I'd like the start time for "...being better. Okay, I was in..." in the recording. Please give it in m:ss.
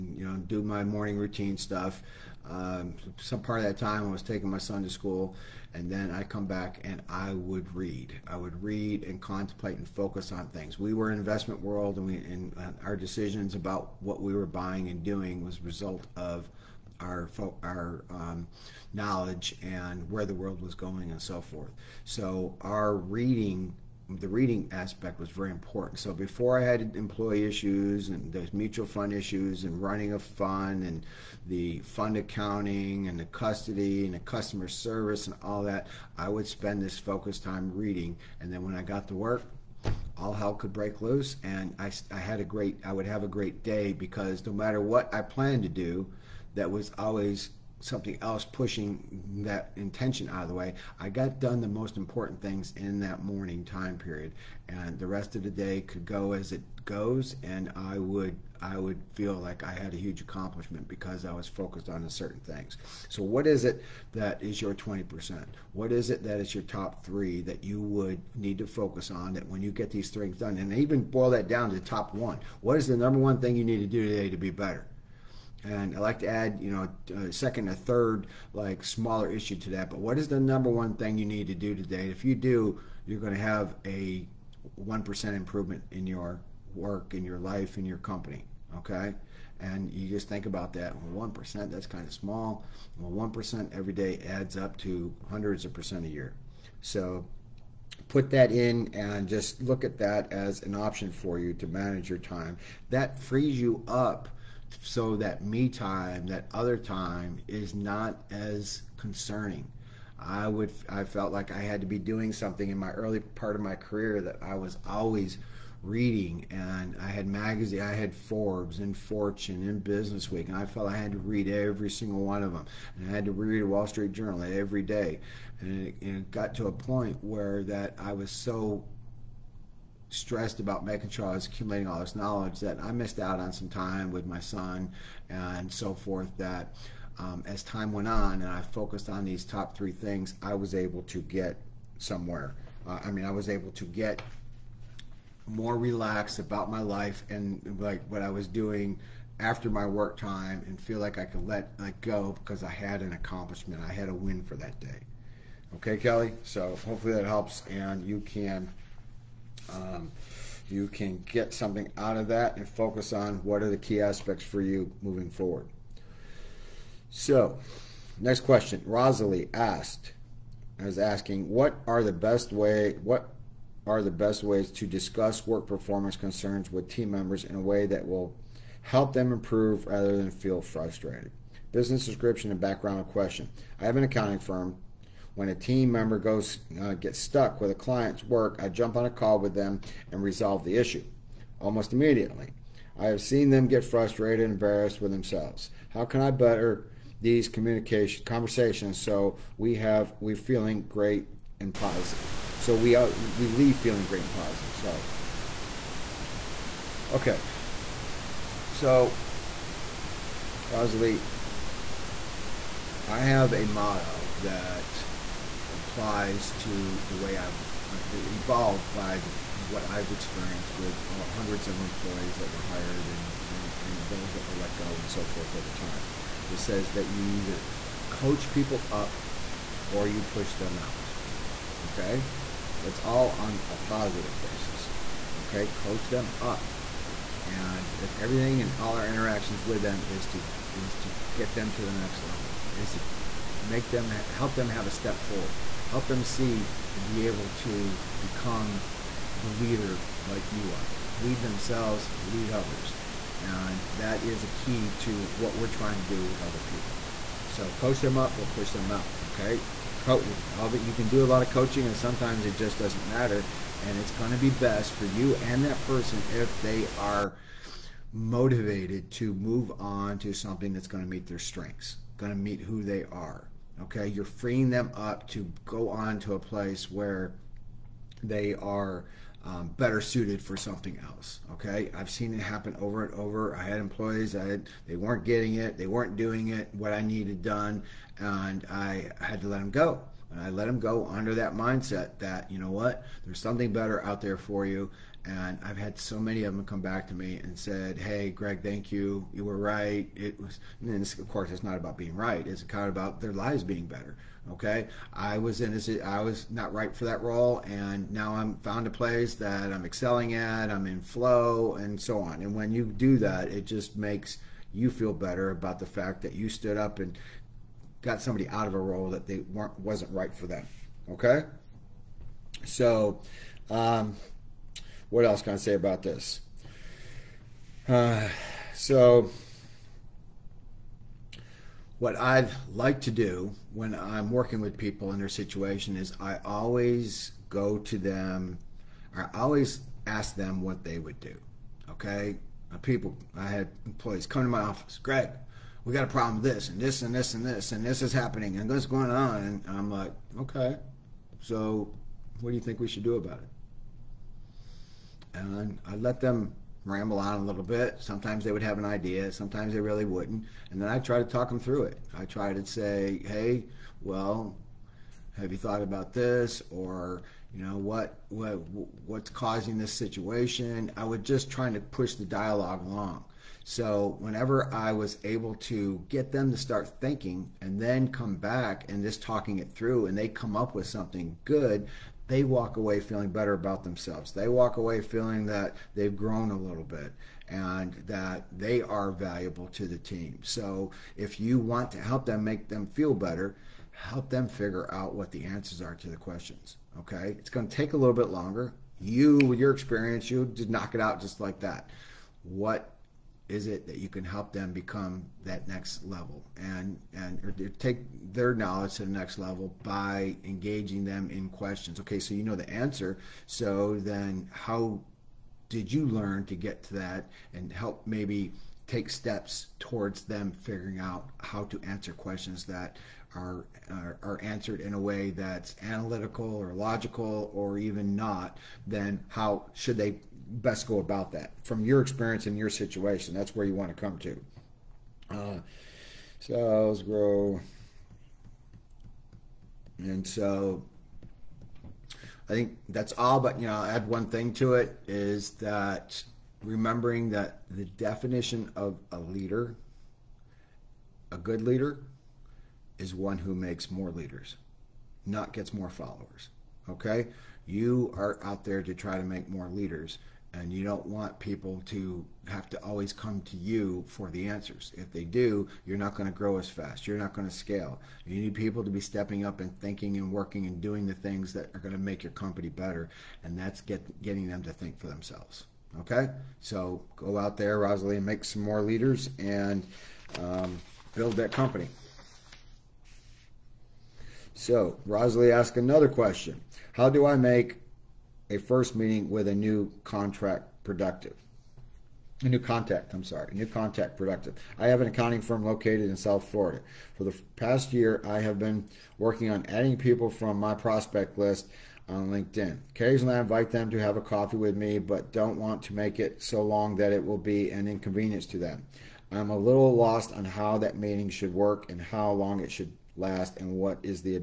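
5:03.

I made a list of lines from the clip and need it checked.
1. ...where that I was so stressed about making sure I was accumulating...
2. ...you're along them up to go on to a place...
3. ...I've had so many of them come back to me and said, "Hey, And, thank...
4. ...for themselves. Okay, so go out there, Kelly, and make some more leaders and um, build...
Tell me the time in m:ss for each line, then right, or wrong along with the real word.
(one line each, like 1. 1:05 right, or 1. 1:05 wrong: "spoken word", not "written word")
1. 2:07 right
2. 4:34 wrong: "freeing", not "along"
3. 4:55 wrong: "Greg", not "And"
4. 7:54 wrong: "Rosalie", not "Kelly".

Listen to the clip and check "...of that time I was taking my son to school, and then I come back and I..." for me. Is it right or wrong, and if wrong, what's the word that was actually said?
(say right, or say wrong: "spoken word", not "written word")
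right.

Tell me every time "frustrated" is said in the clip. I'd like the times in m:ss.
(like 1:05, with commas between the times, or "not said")
3:00, 3:13.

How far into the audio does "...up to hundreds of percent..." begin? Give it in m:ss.
1:34.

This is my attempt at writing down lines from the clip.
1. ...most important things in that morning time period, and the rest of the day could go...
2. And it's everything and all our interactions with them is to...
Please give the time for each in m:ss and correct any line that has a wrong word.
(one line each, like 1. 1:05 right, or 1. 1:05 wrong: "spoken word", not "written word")
1. 0:51 right
2. 3:57 right.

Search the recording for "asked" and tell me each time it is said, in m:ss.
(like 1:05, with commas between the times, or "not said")
2:49, 8:05.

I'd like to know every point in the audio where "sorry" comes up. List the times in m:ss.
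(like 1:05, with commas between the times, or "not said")
3:24, 8:13.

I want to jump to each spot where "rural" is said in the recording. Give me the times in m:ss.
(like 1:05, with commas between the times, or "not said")
not said.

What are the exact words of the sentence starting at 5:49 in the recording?
And I'm like, okay, so what do you think we should do about it?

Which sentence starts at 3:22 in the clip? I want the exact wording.
So we uh, we leave feeling great and positive.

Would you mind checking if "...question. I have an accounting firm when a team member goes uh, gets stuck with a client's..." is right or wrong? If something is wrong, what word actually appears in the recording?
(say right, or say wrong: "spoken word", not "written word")
right.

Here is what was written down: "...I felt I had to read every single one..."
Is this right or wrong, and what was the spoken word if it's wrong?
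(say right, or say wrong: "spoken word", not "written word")
right.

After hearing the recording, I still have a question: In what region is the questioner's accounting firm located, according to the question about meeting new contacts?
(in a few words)
South Florida.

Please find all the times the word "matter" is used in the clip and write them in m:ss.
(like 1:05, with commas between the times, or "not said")
0:44, 4:23.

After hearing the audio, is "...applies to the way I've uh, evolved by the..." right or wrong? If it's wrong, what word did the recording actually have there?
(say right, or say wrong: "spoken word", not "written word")
right.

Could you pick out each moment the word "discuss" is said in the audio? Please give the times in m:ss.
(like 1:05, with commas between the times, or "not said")
2:54.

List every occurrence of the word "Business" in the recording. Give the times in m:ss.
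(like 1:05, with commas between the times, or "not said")
1:59, 3:01.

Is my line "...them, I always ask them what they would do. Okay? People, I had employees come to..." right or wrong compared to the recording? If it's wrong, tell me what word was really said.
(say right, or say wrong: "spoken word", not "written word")
right.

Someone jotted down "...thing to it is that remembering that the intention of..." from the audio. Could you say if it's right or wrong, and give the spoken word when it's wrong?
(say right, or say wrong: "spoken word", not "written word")
wrong: "definition", not "intention".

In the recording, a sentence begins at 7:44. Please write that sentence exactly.
If they do, you're not going to grow as fast.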